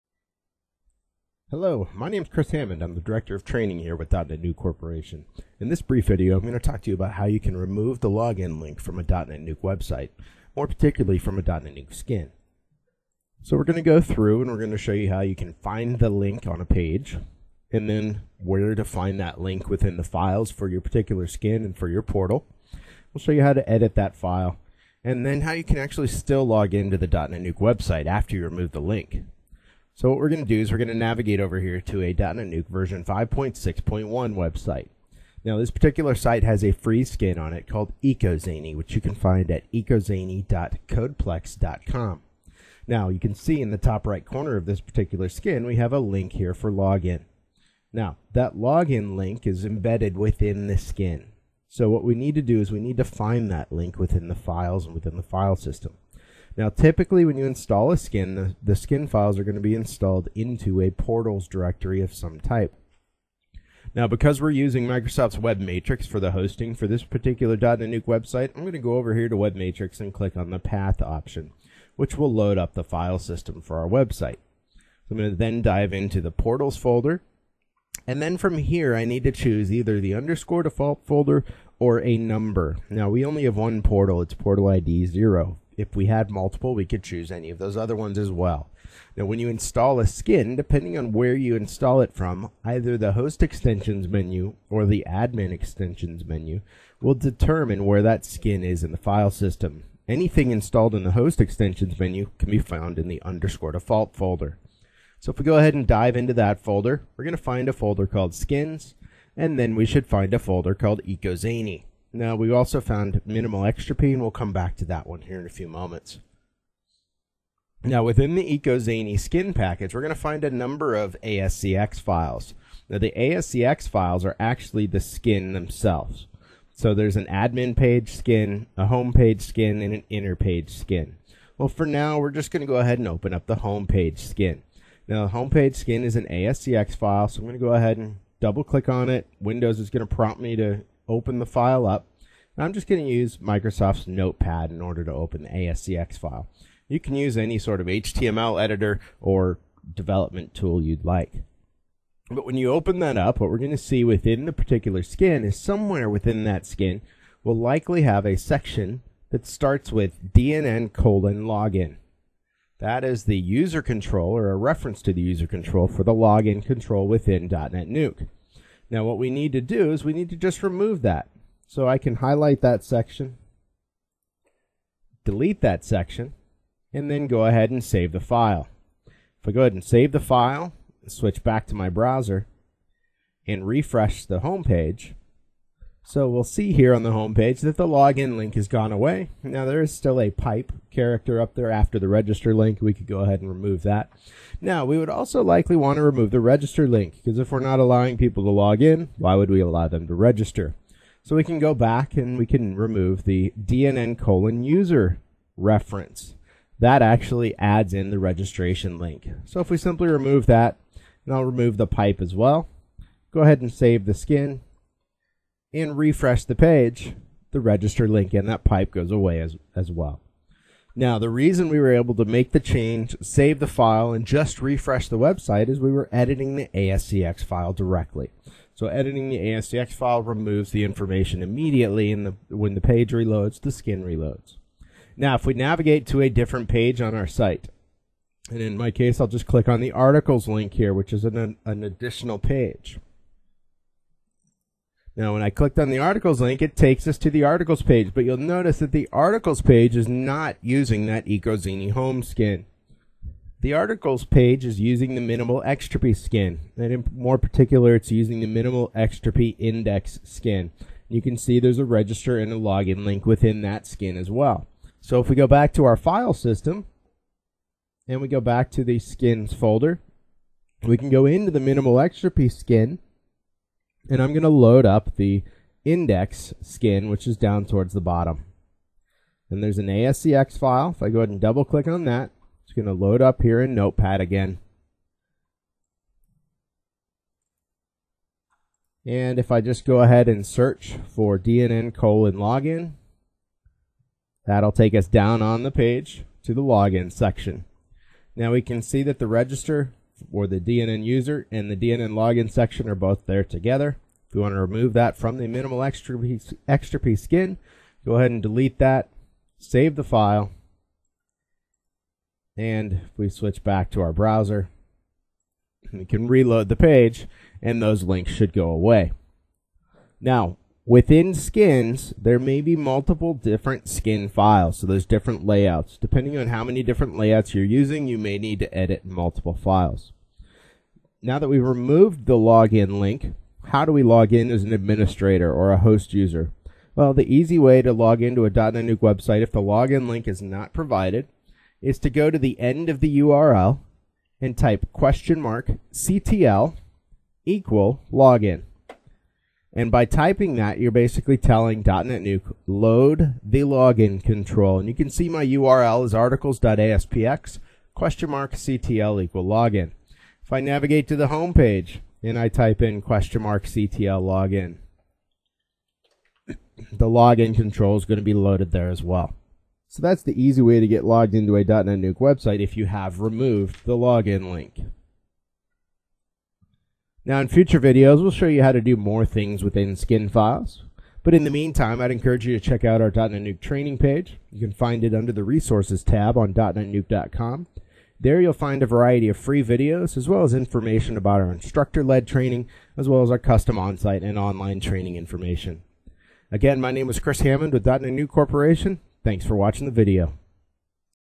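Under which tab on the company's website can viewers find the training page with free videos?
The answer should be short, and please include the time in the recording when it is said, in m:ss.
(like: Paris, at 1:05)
resources, at 6:25.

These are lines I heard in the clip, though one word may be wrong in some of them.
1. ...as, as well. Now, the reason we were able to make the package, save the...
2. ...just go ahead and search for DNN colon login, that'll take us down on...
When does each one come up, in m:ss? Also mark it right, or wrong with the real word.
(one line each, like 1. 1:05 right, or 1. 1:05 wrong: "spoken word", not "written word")
1. 3:39 wrong: "change", not "package"
2. 4:49 right.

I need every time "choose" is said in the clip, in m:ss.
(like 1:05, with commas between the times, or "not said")
1:19, 1:27.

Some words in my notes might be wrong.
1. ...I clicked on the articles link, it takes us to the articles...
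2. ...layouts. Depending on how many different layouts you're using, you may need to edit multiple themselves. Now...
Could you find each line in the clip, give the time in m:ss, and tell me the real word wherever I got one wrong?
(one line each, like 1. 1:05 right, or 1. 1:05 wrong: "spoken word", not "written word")
1. 4:05 right
2. 5:25 wrong: "files", not "themselves".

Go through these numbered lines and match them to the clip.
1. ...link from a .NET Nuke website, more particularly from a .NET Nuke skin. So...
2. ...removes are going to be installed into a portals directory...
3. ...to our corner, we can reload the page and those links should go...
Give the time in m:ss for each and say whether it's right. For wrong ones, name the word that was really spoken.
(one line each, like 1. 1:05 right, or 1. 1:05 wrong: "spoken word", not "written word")
1. 0:08 right
2. 0:59 wrong: "files", not "removes"
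3. 5:13 wrong: "browser", not "corner".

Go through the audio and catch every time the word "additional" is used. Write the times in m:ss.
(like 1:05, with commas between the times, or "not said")
4:01.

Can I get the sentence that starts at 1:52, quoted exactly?
Now, we also found minimal and We'll come back to that one here in a few moments.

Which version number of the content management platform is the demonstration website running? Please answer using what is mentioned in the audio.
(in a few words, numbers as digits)
5.6.1.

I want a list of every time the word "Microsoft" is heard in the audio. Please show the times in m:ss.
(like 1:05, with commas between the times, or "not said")
1:04, 2:23.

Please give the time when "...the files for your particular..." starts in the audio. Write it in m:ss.
0:19.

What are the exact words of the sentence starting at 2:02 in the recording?
Now, the ASCX files are actually the skin themselves.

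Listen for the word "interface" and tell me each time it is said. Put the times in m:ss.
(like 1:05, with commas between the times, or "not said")
not said.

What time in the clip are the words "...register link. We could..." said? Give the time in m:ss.
3:12.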